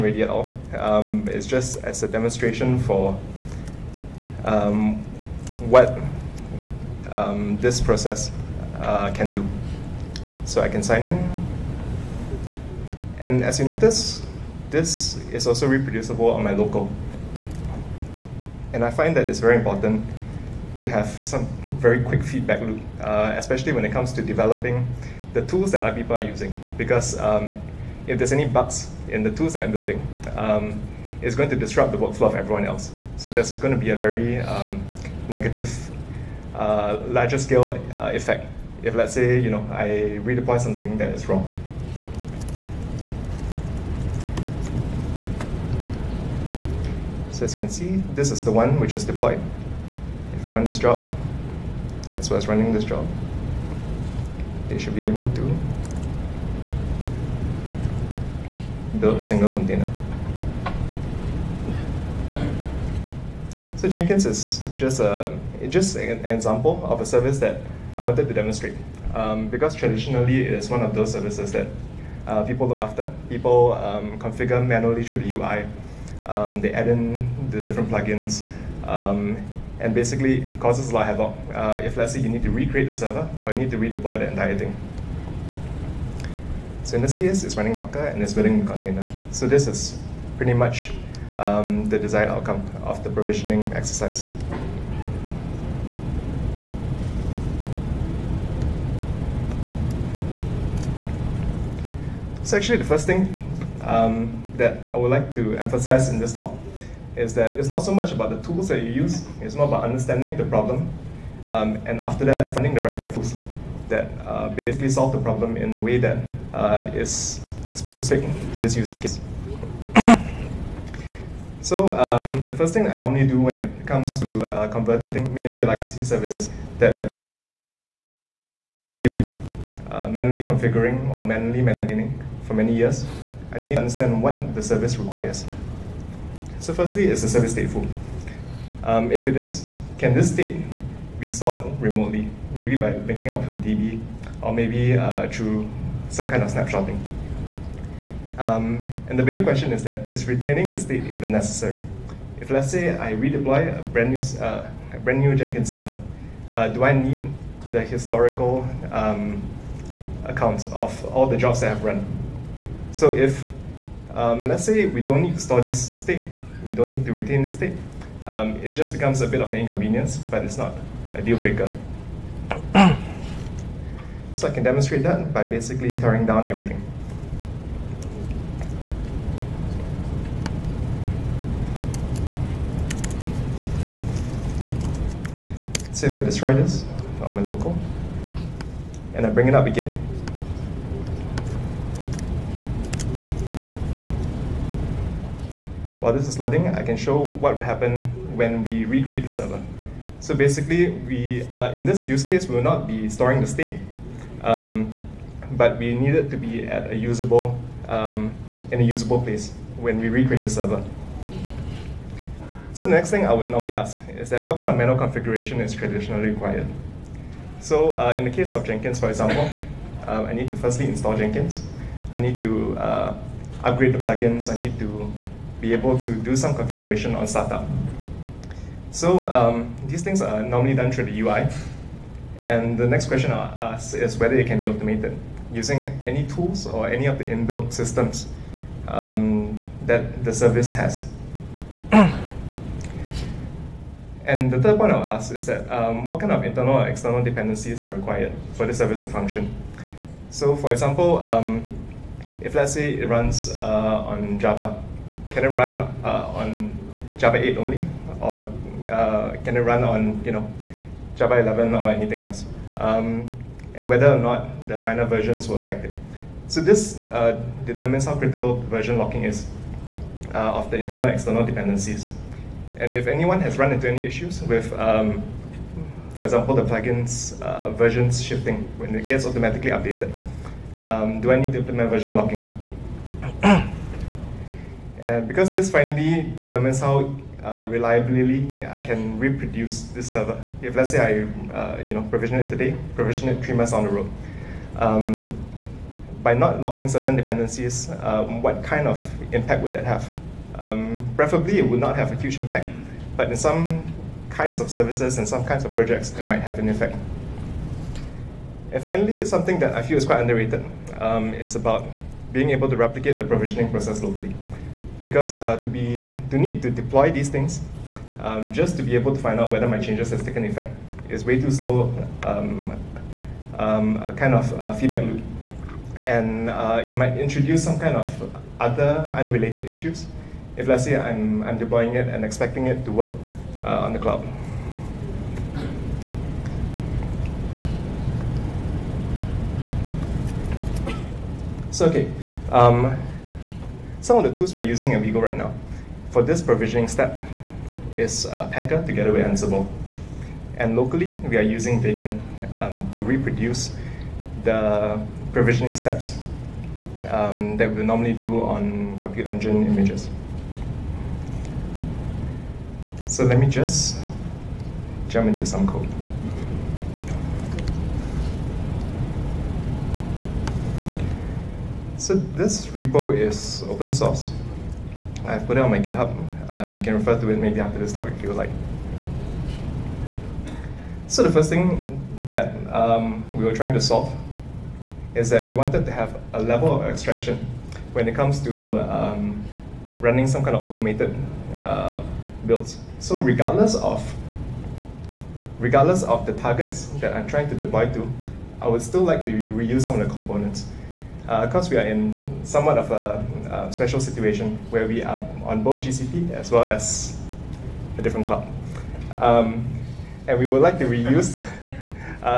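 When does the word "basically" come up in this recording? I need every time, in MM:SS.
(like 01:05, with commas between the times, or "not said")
01:19, 01:54, 02:55, 03:20.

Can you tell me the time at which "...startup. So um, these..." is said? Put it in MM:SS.
03:47.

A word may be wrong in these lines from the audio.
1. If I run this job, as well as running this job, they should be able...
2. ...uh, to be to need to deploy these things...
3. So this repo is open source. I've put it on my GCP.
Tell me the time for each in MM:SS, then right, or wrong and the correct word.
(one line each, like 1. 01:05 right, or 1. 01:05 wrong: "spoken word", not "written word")
1. 00:50 right
2. 05:15 right
3. 06:12 wrong: "GitHub", not "GCP".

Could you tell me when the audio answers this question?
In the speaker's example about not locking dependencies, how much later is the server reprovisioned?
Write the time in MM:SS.
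04:53.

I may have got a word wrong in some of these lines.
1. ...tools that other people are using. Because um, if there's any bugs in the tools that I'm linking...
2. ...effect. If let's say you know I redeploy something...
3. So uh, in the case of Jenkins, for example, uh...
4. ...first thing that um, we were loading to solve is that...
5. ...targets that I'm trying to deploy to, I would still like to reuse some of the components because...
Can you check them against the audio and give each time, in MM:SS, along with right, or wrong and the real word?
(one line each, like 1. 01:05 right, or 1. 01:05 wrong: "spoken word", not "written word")
1. 00:25 wrong: "building", not "linking"
2. 00:38 right
3. 03:37 right
4. 06:21 wrong: "trying", not "loading"
5. 06:36 right.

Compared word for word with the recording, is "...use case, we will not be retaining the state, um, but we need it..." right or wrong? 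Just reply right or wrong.
wrong.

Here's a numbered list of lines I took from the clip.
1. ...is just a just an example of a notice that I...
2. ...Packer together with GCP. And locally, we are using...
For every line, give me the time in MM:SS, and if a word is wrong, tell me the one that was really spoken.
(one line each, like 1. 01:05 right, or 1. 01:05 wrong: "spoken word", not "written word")
1. 01:04 wrong: "service", not "notice"
2. 05:48 wrong: "Ansible", not "GCP".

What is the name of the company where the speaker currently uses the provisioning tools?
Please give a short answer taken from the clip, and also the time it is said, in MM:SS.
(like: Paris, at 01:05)
Wego, at 05:45.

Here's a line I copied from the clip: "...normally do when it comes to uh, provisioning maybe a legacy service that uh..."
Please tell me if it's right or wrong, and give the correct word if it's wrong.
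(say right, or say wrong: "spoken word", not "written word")
wrong: "converting", not "provisioning".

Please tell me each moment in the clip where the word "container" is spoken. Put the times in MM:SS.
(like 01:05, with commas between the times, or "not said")
00:59, 01:28.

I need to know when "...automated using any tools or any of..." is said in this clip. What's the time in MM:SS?
03:54.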